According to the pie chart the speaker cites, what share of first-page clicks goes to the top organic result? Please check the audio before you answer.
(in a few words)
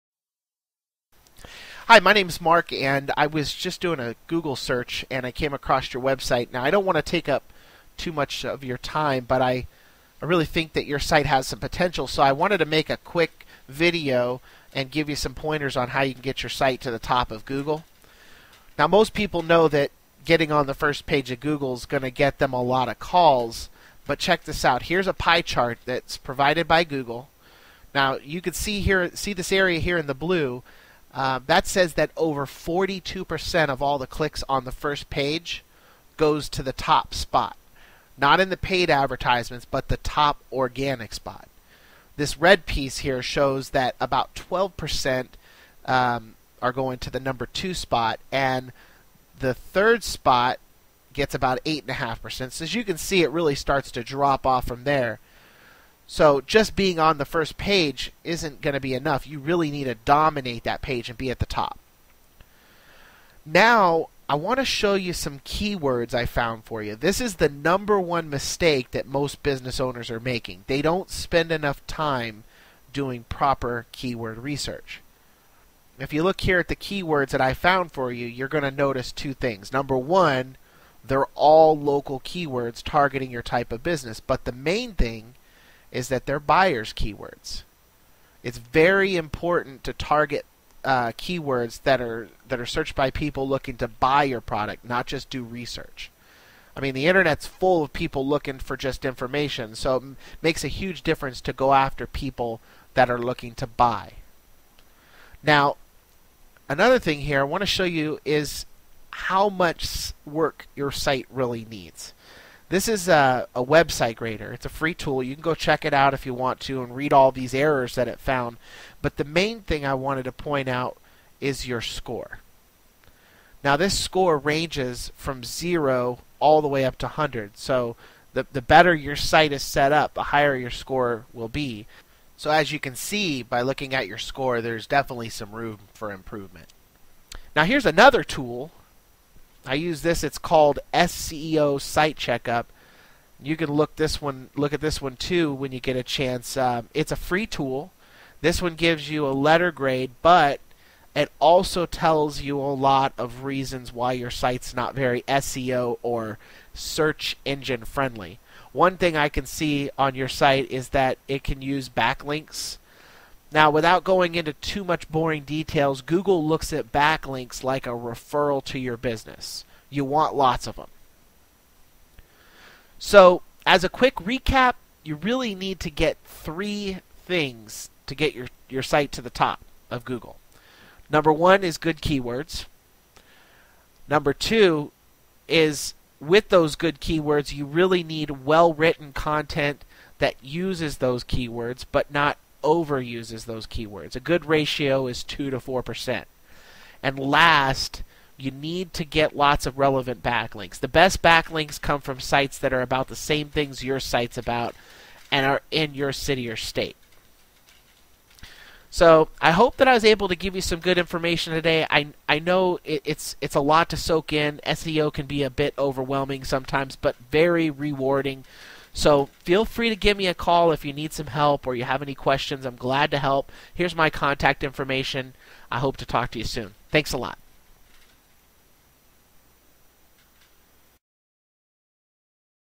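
over 42%.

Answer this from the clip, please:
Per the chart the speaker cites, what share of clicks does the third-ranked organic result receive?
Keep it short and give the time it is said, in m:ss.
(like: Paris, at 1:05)
8.5%, at 0:51.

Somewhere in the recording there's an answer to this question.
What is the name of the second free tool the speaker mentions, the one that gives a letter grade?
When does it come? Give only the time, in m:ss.
2:20.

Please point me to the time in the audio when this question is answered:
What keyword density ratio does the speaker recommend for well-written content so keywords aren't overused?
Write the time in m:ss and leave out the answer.
3:15.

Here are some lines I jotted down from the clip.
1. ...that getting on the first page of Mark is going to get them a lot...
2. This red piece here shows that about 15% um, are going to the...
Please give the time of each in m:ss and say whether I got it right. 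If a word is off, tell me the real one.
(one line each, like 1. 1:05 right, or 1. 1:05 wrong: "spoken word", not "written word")
1. 0:19 wrong: "Google", not "Mark"
2. 0:42 wrong: "12", not "15".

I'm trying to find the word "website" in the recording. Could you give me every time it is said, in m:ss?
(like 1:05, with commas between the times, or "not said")
0:06, 1:53.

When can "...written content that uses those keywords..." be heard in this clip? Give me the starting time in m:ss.
3:08.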